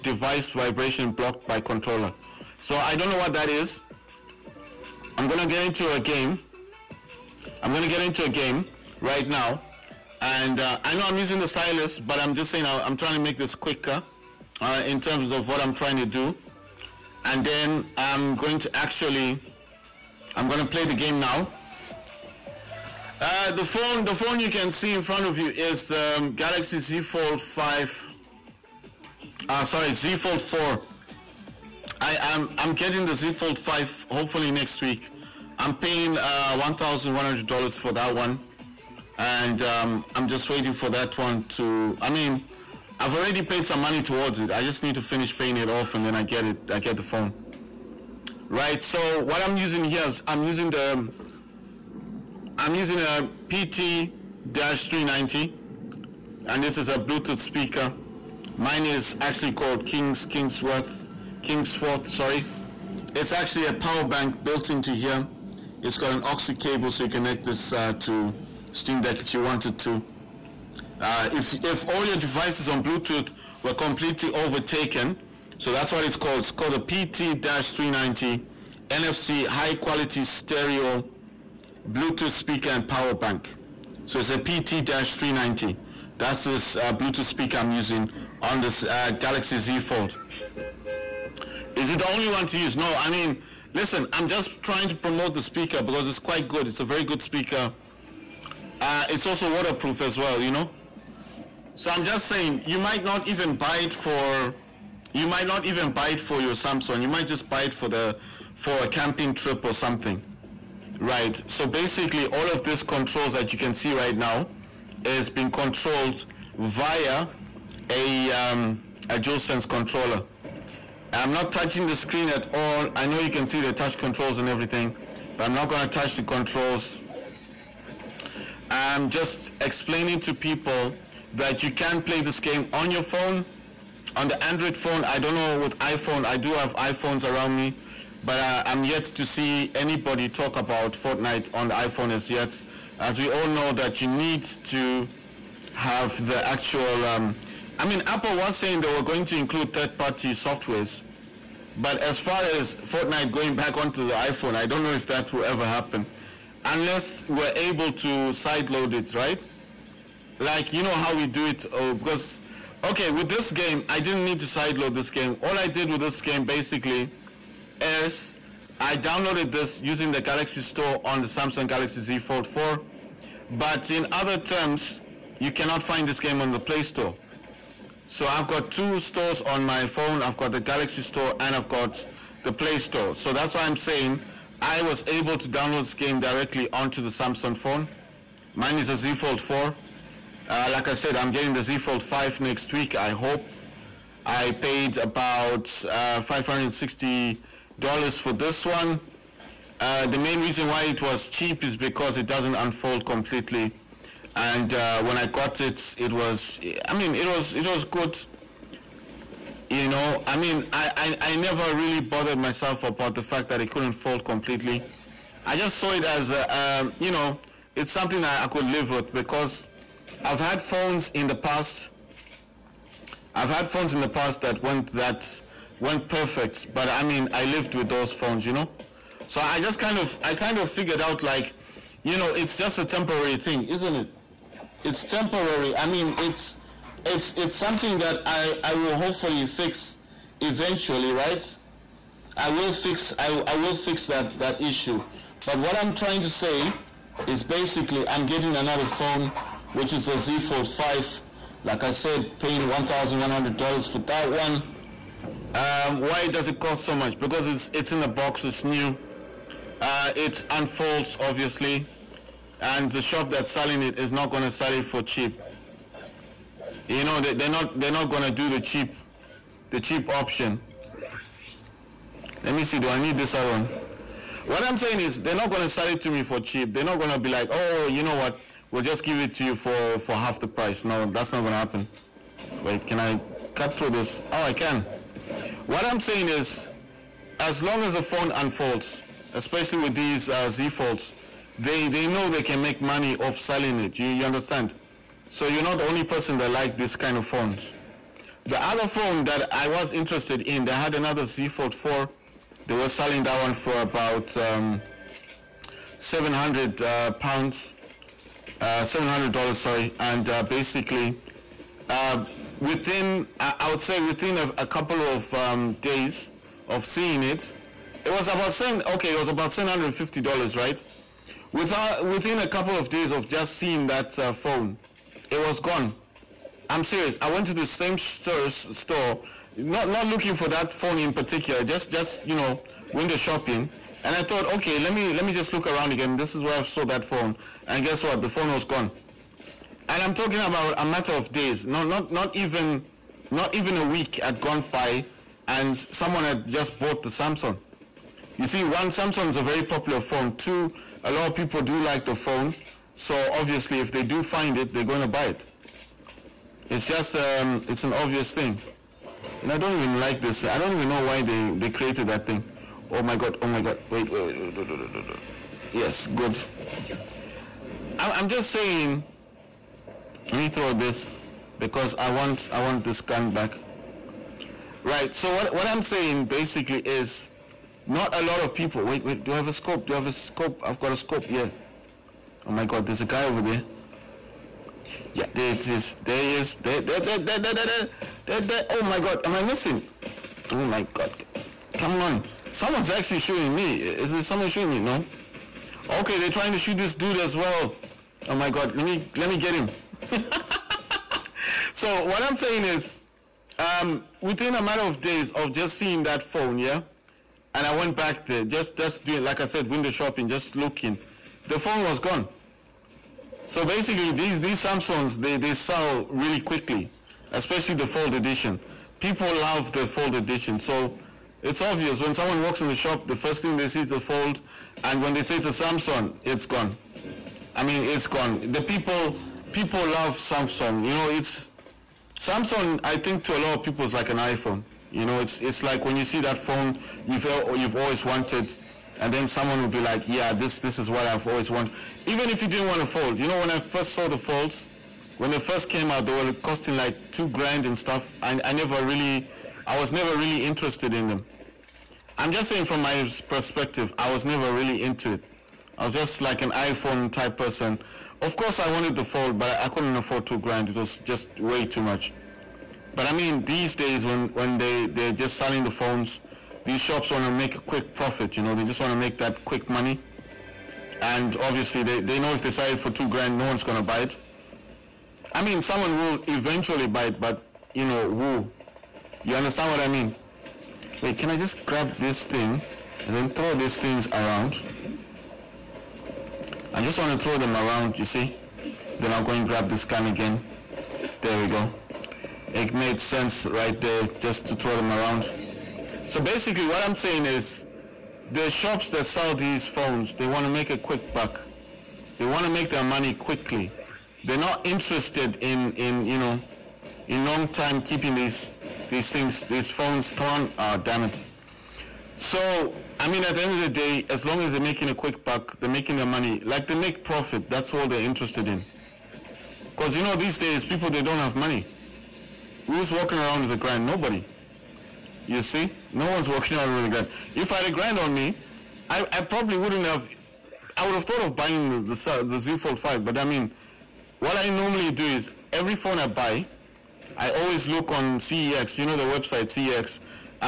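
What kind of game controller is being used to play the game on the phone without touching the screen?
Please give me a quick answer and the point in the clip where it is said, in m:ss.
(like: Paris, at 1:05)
DualSense, at 1:59.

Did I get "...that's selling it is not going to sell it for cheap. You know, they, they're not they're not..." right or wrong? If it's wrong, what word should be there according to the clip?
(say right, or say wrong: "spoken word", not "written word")
right.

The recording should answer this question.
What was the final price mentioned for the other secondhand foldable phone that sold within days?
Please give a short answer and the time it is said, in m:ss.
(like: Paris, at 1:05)
$750, at 5:19.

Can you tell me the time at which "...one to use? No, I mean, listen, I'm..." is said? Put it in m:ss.
1:32.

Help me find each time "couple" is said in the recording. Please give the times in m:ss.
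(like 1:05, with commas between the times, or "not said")
5:14, 5:22.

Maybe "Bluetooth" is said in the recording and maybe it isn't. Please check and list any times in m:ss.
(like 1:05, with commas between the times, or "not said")
0:56, 1:12, 1:21, 1:26.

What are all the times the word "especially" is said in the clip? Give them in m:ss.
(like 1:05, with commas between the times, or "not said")
4:49, 6:57.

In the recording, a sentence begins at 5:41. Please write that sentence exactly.
Not not not even not even a week had gone by and someone had just bought the Samsung.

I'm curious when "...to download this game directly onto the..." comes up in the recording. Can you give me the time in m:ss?
3:05.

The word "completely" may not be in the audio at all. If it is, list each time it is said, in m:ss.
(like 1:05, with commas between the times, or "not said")
1:13, 3:23, 3:34.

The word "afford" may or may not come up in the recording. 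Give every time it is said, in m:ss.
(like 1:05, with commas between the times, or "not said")
7:39.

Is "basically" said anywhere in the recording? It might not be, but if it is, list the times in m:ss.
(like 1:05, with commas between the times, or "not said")
1:51, 2:46, 4:07, 5:10, 6:16, 6:53, 8:16.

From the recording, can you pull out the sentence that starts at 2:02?
I know you can see the touch controls and everything, but I'm not going to touch the controls.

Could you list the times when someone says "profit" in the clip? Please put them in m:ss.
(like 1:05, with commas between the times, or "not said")
7:47, 8:37.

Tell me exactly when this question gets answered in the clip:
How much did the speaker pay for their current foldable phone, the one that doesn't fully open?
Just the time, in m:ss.
3:16.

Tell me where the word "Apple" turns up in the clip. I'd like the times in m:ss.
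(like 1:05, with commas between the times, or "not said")
2:28.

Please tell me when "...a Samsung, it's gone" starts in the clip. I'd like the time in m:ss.
7:05.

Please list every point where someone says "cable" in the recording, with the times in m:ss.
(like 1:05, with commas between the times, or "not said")
1:06.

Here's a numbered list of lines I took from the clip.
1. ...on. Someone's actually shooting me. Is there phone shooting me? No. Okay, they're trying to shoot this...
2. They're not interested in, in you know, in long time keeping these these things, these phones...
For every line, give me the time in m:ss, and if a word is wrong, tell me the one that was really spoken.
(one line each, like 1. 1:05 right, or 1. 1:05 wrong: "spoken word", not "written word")
1. 6:32 wrong: "someone", not "phone"
2. 8:24 right.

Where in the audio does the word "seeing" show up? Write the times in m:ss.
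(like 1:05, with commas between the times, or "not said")
5:16, 5:23, 6:45.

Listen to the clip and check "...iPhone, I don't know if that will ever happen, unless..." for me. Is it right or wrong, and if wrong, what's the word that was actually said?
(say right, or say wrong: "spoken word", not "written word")
right.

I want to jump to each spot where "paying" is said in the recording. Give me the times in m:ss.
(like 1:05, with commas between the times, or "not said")
0:35, 0:45, 4:12.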